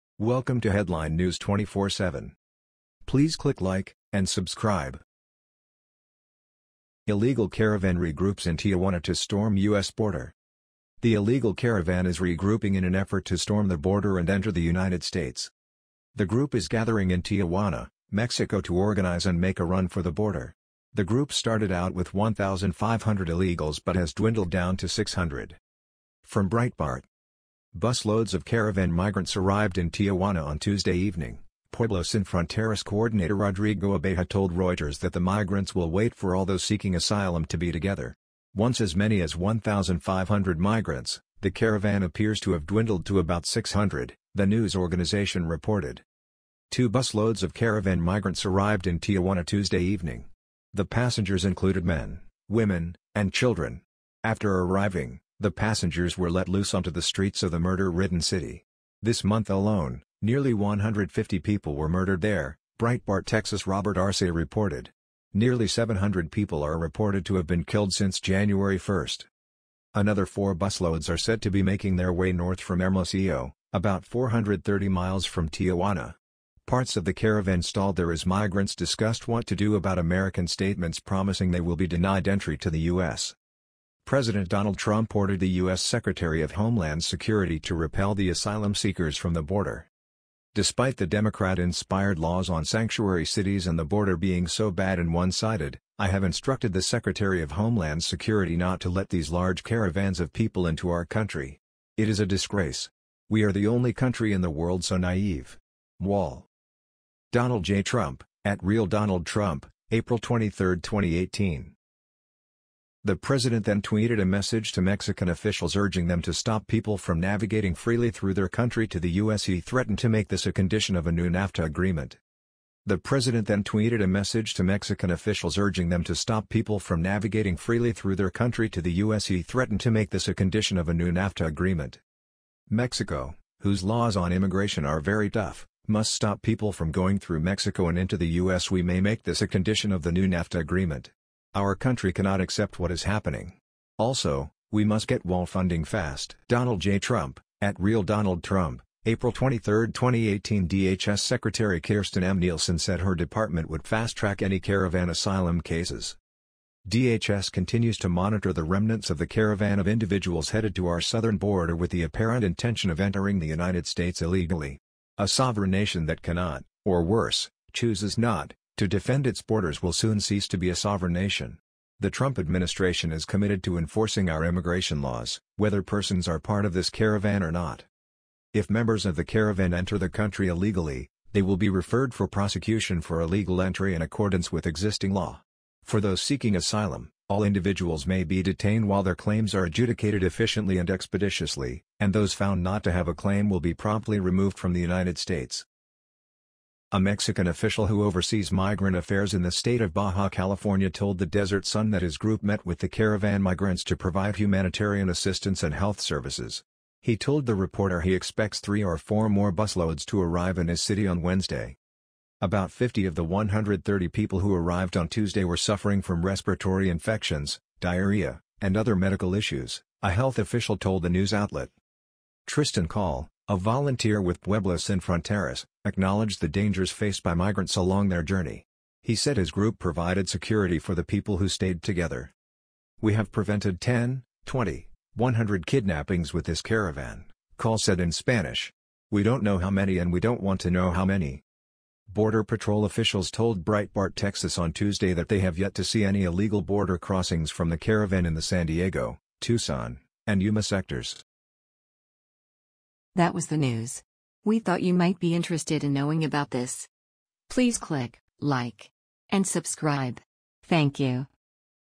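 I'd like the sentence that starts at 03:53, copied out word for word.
We have prevented 10, 20, 100 kidnappings with this caravan, Call said in Spanish.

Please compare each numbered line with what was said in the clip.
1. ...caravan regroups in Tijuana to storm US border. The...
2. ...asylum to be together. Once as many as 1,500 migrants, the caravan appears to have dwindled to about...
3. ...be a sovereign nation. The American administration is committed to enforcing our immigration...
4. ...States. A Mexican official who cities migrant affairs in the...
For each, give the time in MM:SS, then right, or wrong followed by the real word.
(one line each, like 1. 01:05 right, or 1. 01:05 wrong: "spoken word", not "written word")
1. 00:07 right
2. 00:36 right
3. 02:50 wrong: "Trump", not "American"
4. 03:15 wrong: "oversees", not "cities".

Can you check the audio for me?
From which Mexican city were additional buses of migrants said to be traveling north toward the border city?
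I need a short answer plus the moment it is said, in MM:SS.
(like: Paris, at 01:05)
Hermosillo, at 01:12.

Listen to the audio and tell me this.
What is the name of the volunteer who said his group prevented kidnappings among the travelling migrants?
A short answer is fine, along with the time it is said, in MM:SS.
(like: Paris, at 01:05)
Tristan Call, at 03:42.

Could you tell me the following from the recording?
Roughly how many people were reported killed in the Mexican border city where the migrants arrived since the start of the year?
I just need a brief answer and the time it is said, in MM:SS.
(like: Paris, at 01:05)
700, at 01:05.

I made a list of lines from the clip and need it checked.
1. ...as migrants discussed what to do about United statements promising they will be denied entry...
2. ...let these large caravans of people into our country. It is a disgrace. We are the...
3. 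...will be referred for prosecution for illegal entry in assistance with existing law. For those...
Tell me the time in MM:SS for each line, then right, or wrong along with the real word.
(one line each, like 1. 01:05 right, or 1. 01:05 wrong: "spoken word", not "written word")
1. 01:18 wrong: "American", not "United"
2. 01:38 right
3. 03:01 wrong: "accordance", not "assistance".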